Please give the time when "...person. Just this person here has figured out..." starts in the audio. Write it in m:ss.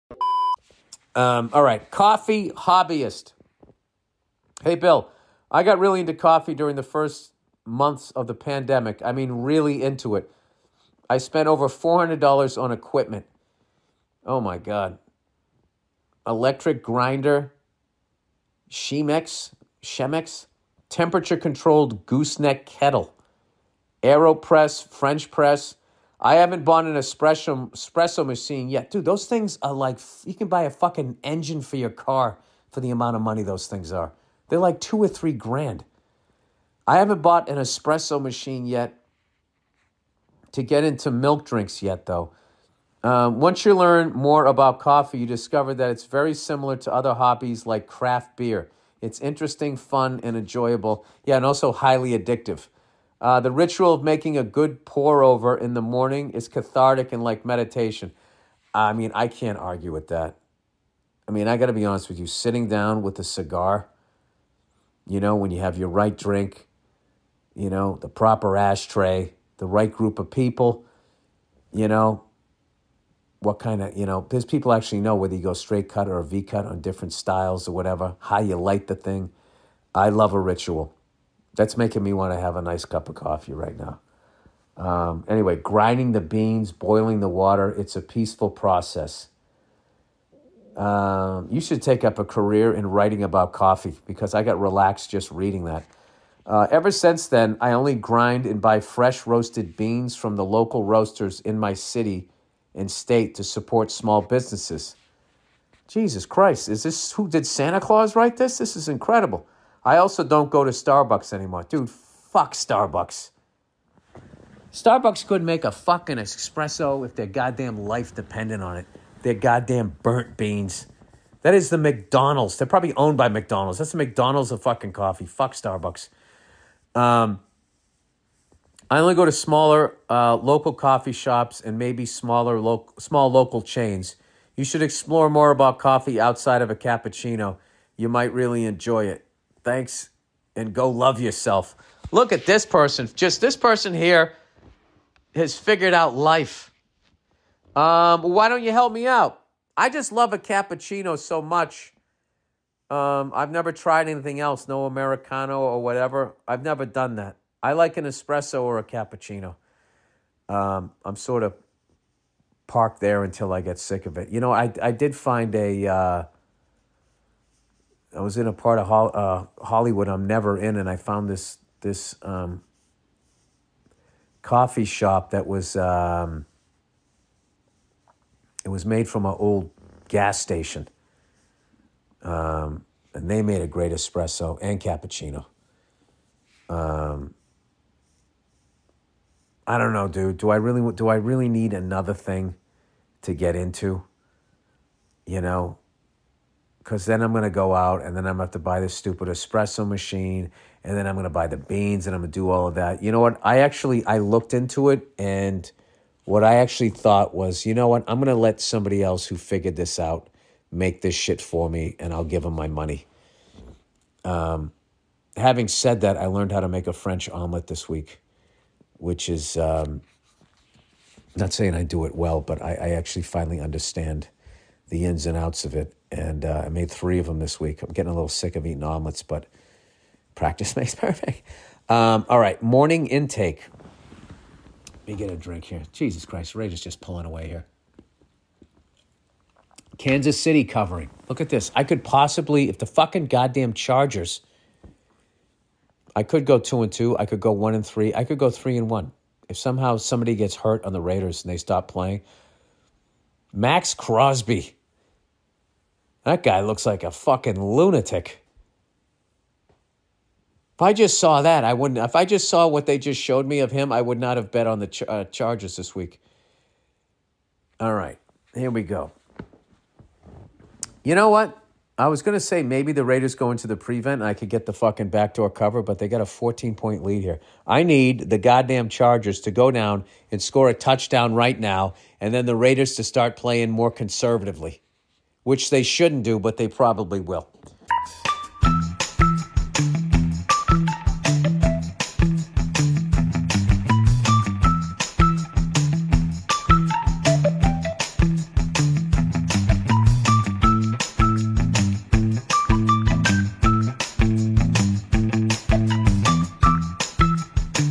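2:22.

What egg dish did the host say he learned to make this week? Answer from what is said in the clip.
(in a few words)
French omelet.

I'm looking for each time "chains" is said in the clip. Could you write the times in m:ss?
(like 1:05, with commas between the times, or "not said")
2:13.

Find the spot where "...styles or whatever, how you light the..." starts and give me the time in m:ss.
1:17.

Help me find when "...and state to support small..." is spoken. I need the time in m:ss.
1:42.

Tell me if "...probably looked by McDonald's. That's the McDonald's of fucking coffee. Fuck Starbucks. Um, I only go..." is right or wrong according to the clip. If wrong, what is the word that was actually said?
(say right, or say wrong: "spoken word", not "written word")
wrong: "owned", not "looked".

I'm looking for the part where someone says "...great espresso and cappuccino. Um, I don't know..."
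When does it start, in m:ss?
3:03.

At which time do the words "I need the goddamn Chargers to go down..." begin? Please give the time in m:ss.
4:37.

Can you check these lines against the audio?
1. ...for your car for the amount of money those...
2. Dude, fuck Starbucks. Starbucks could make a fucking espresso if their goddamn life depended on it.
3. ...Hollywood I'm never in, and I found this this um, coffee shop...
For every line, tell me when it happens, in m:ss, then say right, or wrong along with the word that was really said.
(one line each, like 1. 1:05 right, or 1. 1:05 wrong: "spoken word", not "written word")
1. 0:31 right
2. 1:51 right
3. 2:49 right.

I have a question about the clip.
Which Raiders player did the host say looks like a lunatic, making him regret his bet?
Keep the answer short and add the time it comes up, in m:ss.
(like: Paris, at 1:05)
Maxx Crosby, at 4:13.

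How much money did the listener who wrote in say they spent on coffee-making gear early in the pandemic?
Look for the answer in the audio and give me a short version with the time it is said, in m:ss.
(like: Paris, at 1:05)
over $400, at 0:11.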